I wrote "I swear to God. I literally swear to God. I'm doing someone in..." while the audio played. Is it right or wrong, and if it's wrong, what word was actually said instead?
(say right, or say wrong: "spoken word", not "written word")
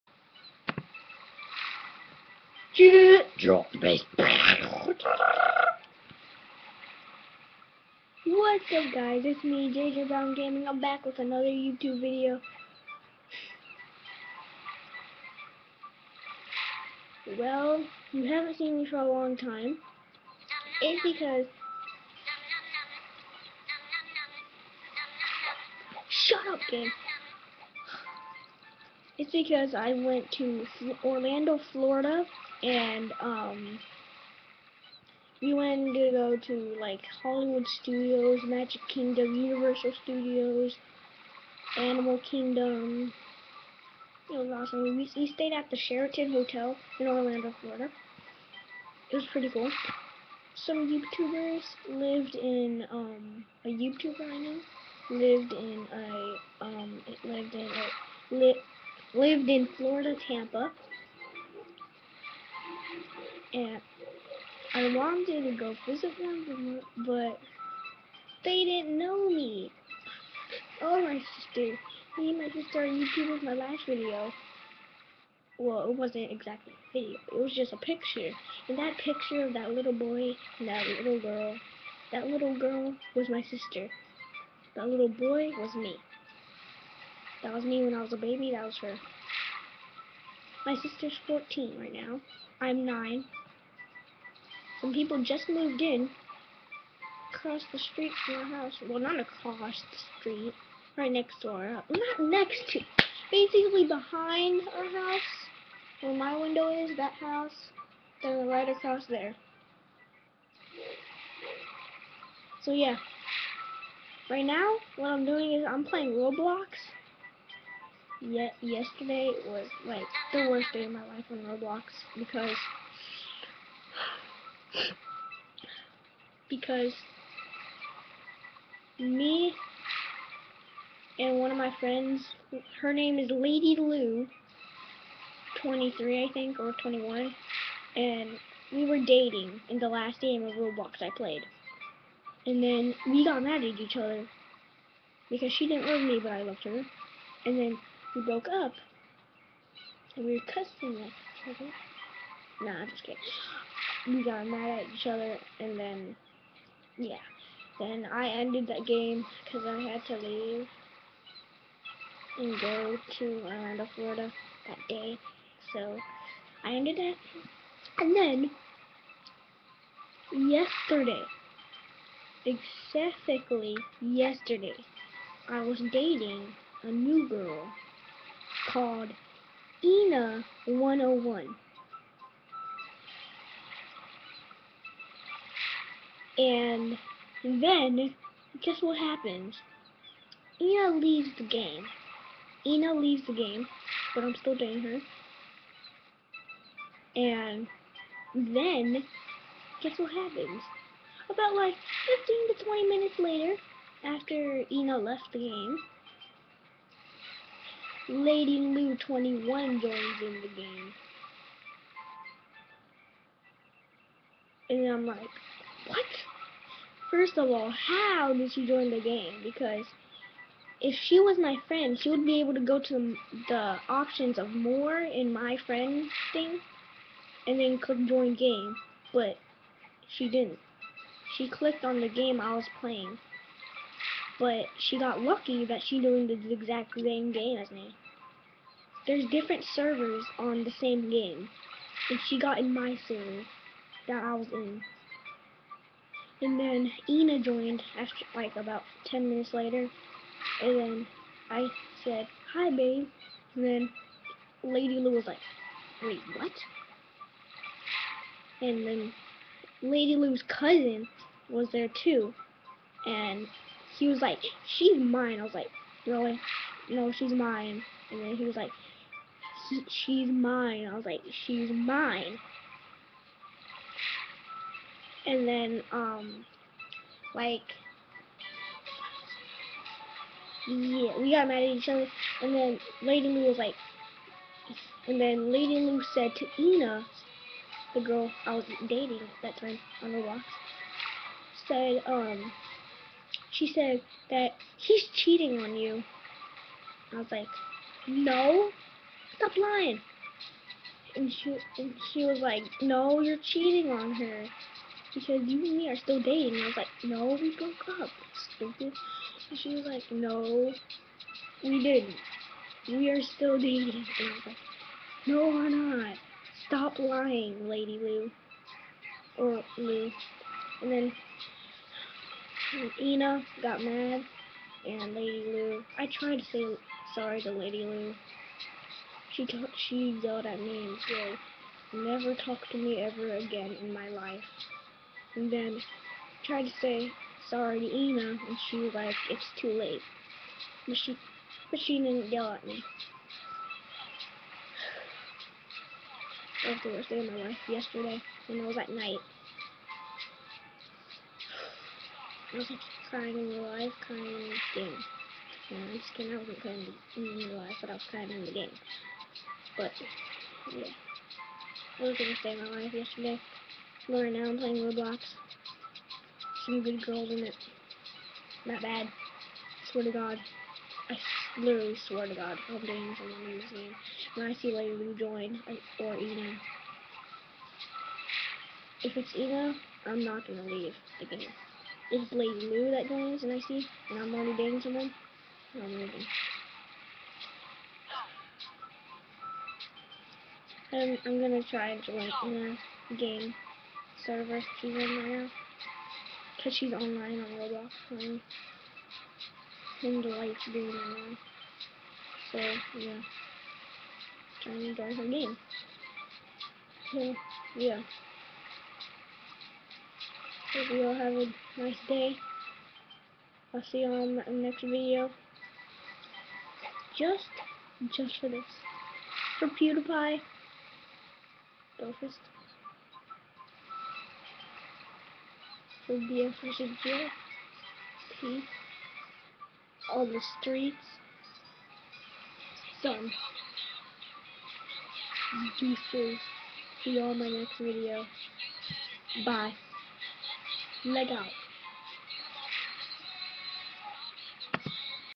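right.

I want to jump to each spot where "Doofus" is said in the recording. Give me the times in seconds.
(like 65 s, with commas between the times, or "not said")
421 s.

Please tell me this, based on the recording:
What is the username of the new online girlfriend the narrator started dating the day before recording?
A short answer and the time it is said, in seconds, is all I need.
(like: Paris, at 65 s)
ENA 101, at 179 s.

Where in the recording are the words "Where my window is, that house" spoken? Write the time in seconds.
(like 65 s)
106 s.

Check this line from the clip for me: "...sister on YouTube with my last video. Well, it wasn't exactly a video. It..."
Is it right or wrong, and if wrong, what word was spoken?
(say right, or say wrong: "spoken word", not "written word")
right.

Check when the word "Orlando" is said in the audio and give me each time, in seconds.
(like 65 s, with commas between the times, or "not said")
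31 s, 47 s, 163 s.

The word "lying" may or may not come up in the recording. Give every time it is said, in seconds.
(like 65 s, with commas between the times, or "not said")
299 s, 316 s.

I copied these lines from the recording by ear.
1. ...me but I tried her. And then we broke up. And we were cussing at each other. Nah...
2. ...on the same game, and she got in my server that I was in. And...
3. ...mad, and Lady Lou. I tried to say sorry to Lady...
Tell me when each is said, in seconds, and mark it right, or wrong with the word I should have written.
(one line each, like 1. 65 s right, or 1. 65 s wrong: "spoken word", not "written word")
1. 146 s wrong: "loved", not "tried"
2. 240 s right
3. 323 s right.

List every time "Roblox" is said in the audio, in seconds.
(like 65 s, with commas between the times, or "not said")
116 s, 121 s, 140 s, 364 s, 397 s.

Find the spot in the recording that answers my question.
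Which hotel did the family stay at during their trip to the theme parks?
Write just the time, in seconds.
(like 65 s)
45 s.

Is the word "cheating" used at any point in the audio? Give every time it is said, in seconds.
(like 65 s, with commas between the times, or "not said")
295 s, 303 s.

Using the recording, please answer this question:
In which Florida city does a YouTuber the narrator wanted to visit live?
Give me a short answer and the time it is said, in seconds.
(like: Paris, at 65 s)
Tampa, at 60 s.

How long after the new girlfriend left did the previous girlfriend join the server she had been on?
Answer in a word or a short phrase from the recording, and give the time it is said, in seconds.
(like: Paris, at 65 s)
15 to 20 minutes, at 202 s.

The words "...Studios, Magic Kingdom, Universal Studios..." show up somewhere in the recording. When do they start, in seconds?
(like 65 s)
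37 s.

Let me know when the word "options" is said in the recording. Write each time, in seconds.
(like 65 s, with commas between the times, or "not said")
223 s.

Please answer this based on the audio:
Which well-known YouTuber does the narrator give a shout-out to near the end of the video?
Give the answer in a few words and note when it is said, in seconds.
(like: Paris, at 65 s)
PewDiePie, at 419 s.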